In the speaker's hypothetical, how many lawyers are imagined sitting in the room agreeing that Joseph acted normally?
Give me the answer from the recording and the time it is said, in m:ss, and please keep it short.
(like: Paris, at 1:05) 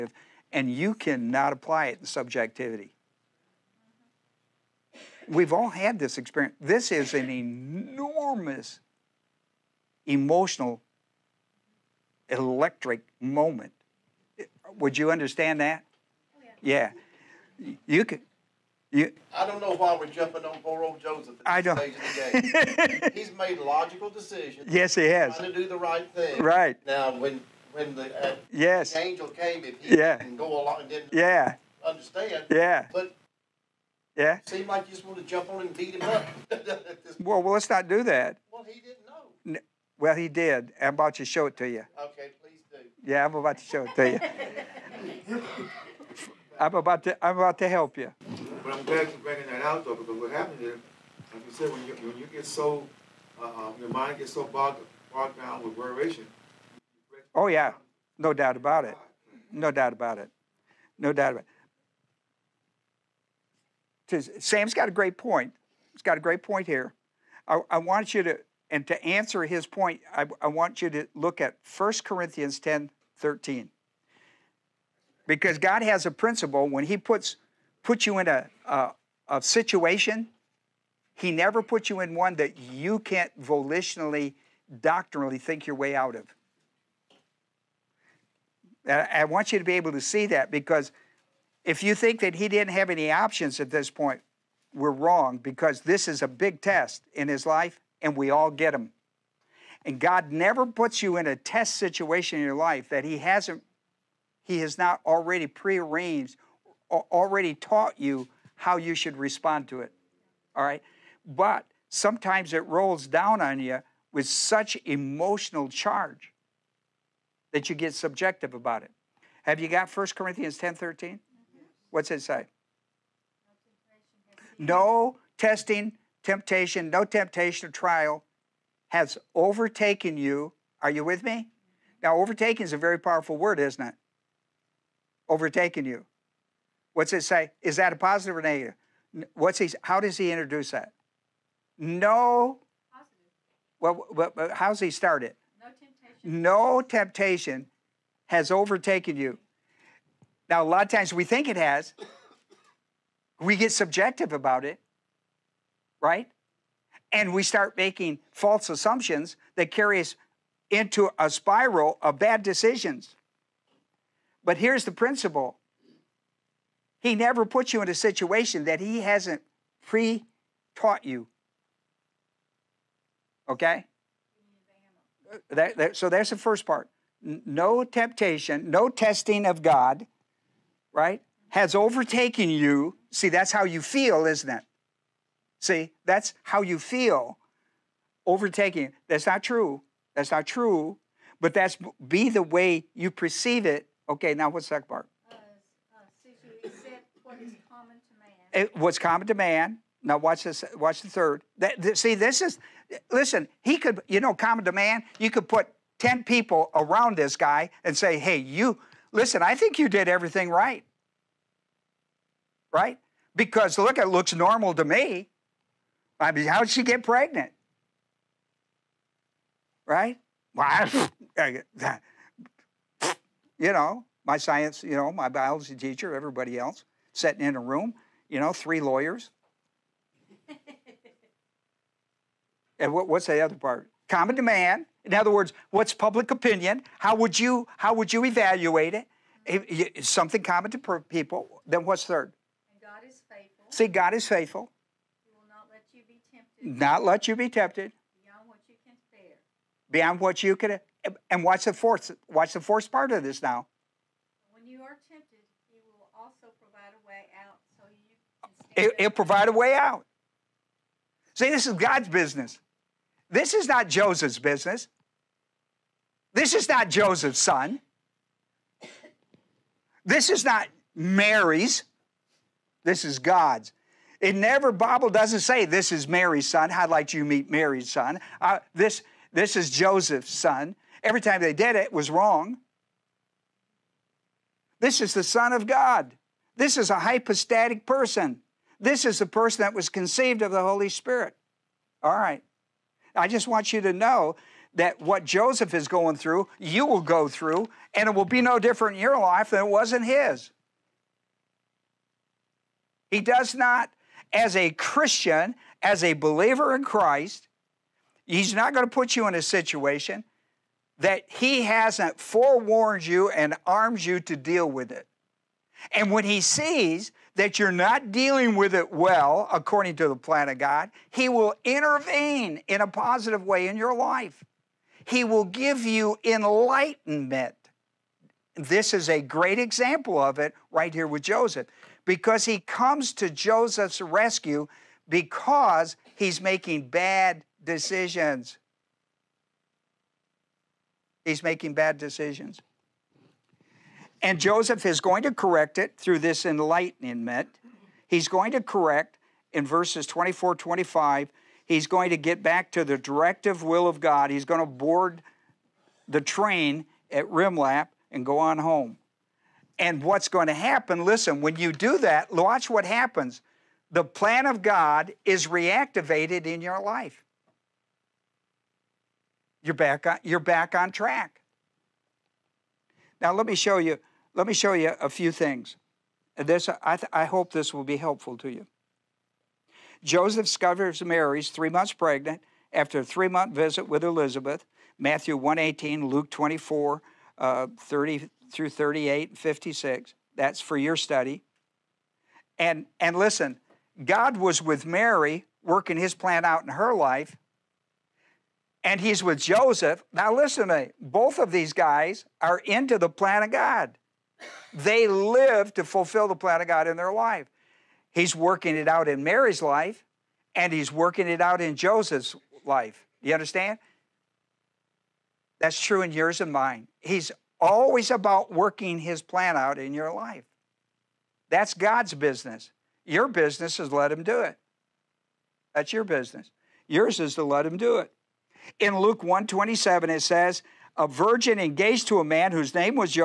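3, at 3:48.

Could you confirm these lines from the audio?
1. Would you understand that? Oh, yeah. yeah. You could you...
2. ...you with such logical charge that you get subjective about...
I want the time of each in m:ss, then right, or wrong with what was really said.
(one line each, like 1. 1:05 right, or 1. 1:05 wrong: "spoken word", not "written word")
1. 0:14 right
2. 1:53 wrong: "emotional", not "logical".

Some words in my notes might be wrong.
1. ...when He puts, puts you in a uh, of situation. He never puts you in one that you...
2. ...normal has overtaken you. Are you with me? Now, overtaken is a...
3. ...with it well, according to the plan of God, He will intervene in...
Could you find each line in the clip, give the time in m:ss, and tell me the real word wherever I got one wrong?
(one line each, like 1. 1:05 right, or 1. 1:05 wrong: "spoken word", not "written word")
1. 1:16 right
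2. 2:07 wrong: "trial", not "normal"
3. 5:18 right.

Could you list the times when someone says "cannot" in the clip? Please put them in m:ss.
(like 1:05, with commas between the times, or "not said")
0:00.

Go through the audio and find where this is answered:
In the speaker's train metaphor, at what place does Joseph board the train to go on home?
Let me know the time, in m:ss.
5:57.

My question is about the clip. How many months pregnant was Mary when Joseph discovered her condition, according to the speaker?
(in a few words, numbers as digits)
3.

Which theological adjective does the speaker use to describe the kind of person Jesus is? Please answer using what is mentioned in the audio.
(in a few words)
hypostatic.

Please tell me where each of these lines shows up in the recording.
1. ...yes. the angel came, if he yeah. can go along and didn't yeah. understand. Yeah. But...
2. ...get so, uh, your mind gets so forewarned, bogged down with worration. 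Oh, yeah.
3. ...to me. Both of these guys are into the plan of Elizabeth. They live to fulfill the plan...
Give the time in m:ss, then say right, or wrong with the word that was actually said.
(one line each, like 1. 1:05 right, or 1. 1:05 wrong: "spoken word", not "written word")
1. 0:28 right
2. 0:52 wrong: "bogged", not "forewarned"
3. 6:40 wrong: "God", not "Elizabeth".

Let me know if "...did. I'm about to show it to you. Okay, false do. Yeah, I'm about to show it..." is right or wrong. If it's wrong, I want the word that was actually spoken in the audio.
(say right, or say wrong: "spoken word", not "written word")
wrong: "please", not "false".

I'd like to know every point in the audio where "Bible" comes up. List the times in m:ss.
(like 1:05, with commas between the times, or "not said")
4:34.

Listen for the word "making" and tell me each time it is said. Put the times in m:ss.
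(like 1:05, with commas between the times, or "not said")
2:37, 5:36, 5:41.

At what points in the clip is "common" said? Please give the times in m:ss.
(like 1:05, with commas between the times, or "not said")
3:18, 3:24, 3:54, 4:00.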